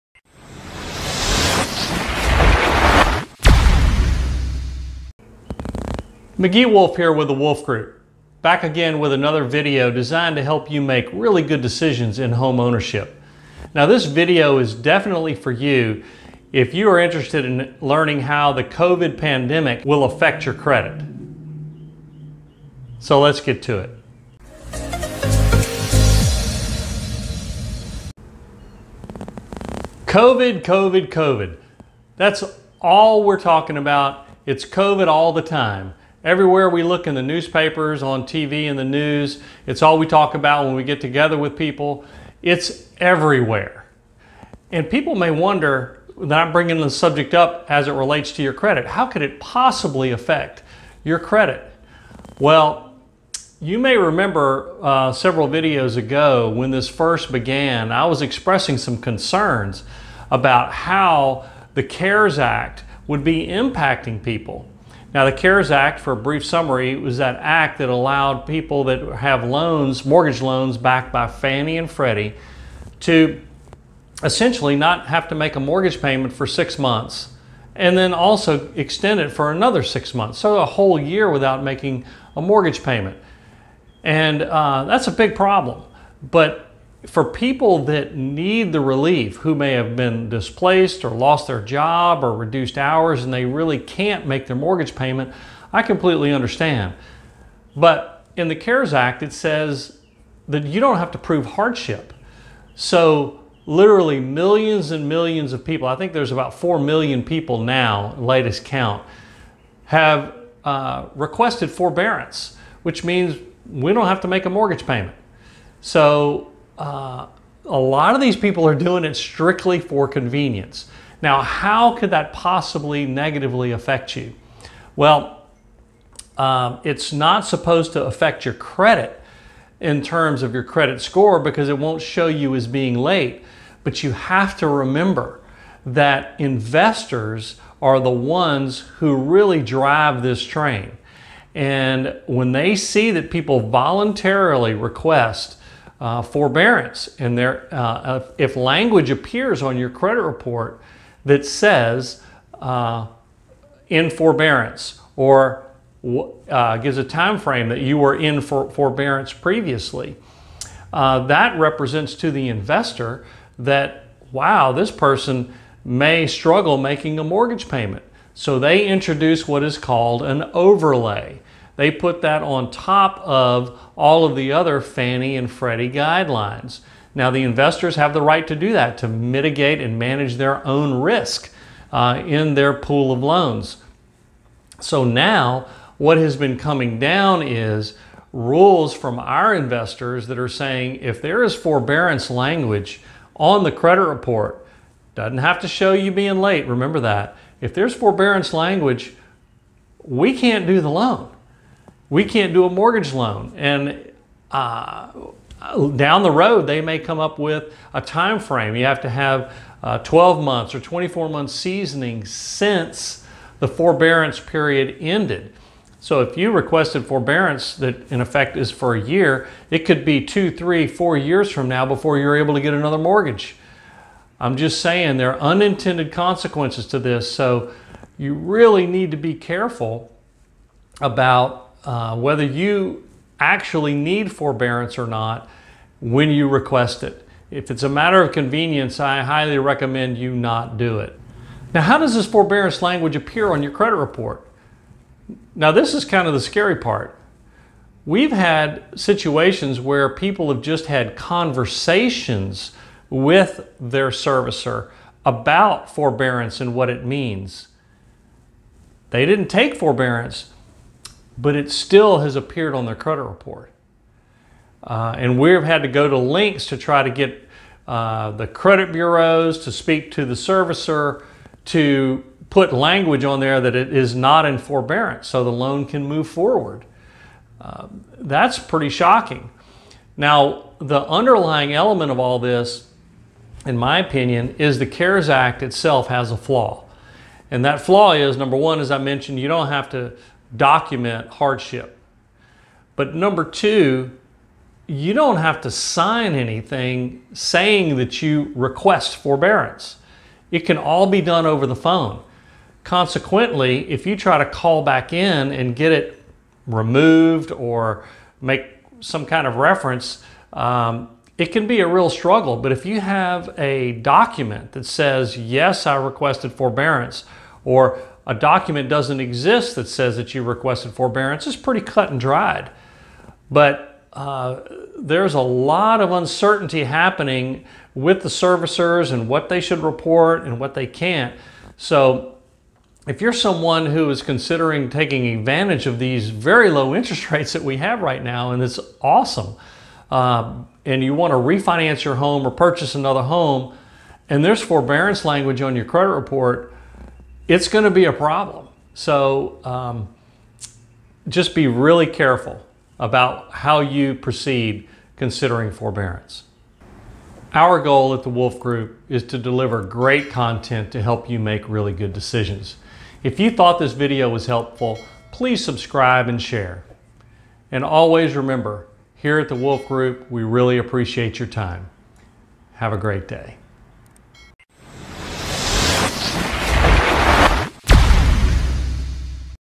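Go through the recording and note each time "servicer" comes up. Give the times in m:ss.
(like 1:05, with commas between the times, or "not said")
4:14, 4:30, 5:28.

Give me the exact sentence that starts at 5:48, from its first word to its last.
So um, just be really careful about how you proceed considering forbearance.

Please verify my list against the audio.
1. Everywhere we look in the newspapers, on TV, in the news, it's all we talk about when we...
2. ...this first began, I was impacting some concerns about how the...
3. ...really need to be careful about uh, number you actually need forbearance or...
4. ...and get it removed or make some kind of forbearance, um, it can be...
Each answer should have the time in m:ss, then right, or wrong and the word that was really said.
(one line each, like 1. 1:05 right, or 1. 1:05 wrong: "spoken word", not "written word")
1. 0:36 right
2. 0:56 wrong: "expressing", not "impacting"
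3. 3:48 wrong: "whether", not "number"
4. 5:05 wrong: "reference", not "forbearance".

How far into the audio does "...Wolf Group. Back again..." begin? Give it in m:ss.
0:07.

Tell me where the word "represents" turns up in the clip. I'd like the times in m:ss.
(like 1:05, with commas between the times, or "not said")
2:41.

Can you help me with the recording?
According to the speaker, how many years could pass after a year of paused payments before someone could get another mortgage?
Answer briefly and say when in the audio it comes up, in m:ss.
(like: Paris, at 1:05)
2 to 4 years, at 3:40.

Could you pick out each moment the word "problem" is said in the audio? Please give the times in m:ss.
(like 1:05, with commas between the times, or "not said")
1:25, 5:48.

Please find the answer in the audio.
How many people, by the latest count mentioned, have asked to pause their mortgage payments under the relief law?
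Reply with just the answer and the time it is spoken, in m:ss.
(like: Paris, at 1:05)
about 4 million, at 1:46.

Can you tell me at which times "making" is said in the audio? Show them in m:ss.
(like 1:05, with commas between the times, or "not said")
1:21, 2:46.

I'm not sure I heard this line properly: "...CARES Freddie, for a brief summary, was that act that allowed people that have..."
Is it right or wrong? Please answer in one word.
wrong.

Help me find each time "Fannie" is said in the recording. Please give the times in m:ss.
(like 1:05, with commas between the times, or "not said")
1:11, 2:54.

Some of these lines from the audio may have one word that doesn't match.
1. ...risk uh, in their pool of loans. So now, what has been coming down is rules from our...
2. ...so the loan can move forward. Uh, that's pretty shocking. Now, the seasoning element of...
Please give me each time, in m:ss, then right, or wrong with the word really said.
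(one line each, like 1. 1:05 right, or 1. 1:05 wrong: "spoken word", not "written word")
1. 3:01 right
2. 4:35 wrong: "underlying", not "seasoning".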